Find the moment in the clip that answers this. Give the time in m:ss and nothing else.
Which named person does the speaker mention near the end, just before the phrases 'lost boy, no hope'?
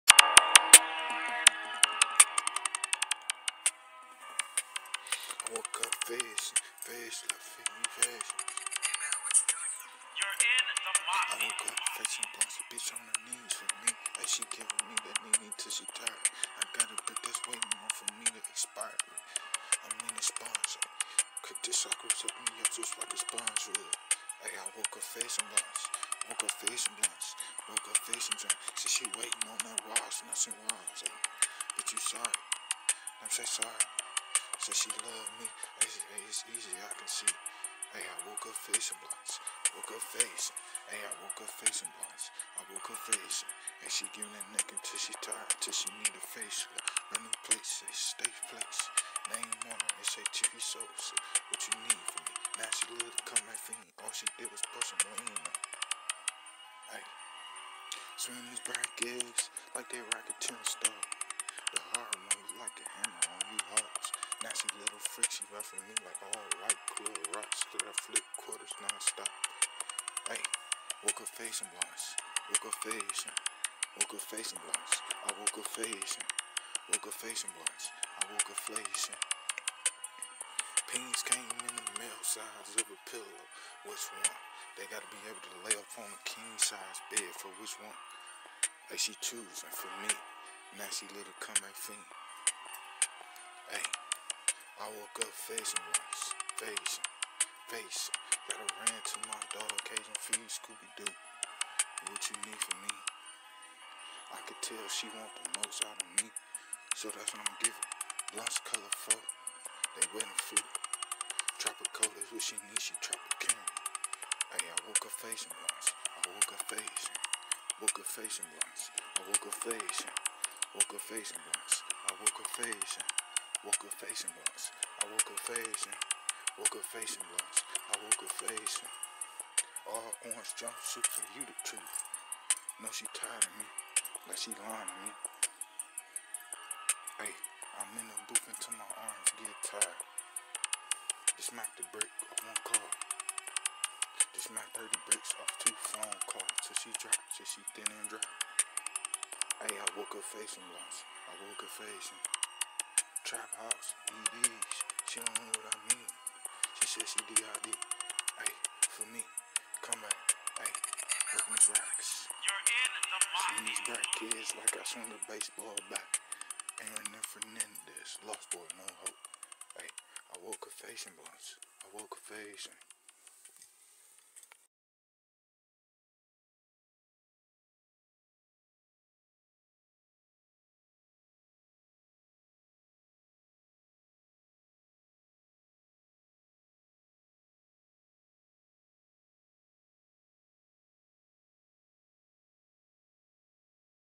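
2:46.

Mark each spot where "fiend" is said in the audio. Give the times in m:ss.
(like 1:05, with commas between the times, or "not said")
1:31.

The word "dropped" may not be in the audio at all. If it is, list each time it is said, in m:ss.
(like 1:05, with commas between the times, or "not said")
2:26.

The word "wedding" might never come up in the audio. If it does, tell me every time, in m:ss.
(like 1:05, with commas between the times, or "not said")
1:50.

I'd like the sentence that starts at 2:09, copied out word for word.
All orange jumpsuits are you the truth.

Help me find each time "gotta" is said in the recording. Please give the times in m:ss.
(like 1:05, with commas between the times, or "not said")
1:24, 1:38.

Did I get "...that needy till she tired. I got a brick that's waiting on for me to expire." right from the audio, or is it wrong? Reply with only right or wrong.
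right.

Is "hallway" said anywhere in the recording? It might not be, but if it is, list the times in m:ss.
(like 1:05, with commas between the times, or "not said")
not said.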